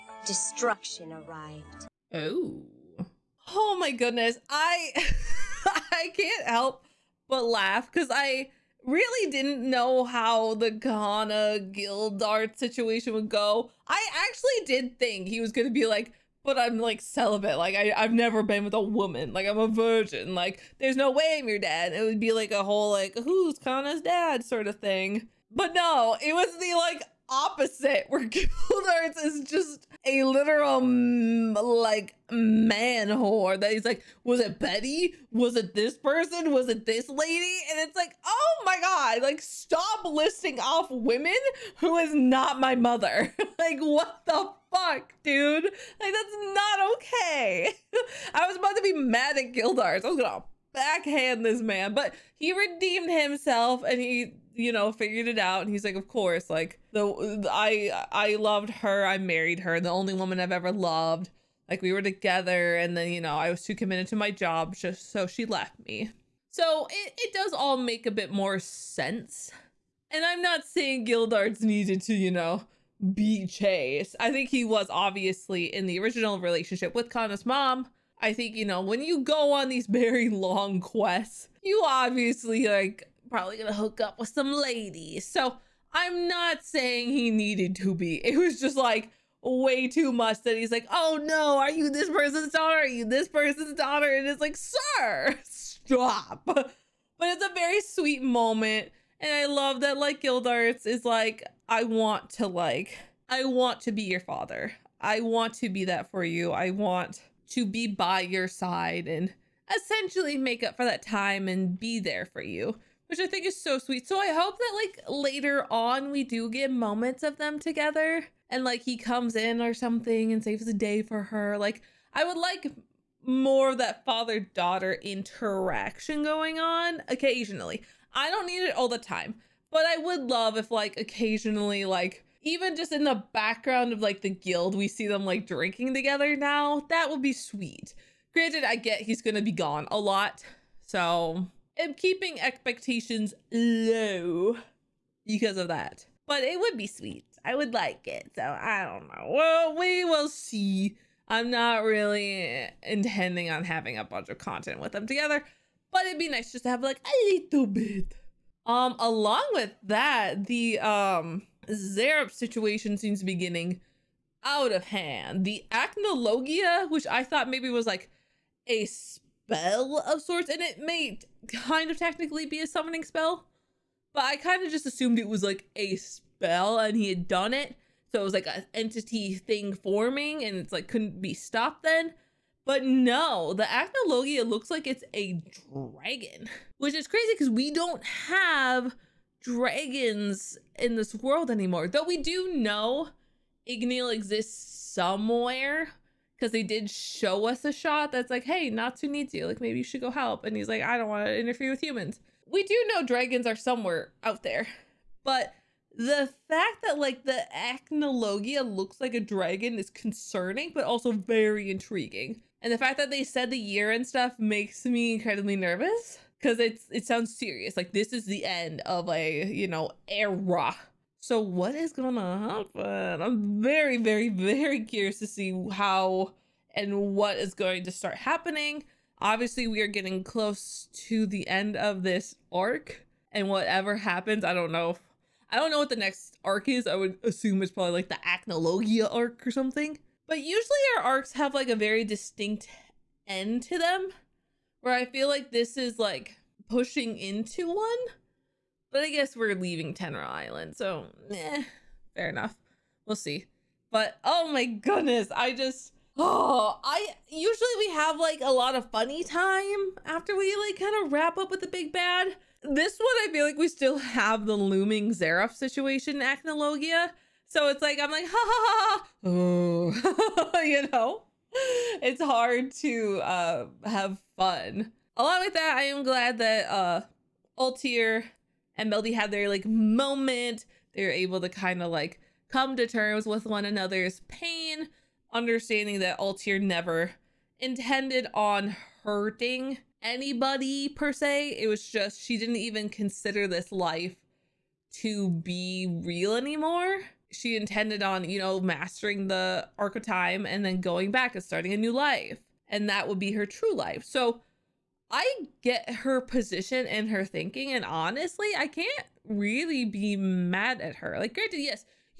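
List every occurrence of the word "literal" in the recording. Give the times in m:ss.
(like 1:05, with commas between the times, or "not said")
0:30.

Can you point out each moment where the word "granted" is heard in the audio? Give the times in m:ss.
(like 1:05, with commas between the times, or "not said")
2:18, 5:11.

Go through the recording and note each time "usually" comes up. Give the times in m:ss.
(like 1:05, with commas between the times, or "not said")
4:00, 4:17.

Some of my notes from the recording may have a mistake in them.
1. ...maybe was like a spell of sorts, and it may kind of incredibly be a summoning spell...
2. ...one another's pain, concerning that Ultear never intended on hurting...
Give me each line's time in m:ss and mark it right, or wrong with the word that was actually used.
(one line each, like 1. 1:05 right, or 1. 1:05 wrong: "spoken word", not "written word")
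1. 2:47 wrong: "technically", not "incredibly"
2. 4:43 wrong: "understanding", not "concerning".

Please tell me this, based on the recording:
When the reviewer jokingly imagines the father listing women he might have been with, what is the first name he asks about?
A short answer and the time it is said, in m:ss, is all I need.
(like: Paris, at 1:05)
Betty, at 0:34.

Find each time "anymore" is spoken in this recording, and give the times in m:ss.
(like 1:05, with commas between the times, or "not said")
3:11, 4:56.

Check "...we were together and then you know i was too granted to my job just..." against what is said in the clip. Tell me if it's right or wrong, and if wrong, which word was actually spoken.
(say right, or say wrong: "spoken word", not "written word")
wrong: "committed", not "granted".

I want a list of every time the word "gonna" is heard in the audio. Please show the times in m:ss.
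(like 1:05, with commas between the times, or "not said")
0:50, 1:23, 2:19, 3:41.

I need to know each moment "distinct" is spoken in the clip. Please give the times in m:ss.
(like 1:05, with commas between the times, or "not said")
4:02.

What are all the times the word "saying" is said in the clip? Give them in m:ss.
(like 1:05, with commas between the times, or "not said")
1:10, 1:26.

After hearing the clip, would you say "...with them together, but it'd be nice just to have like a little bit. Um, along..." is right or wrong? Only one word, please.
right.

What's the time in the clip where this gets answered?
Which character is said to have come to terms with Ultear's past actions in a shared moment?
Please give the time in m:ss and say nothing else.
4:38.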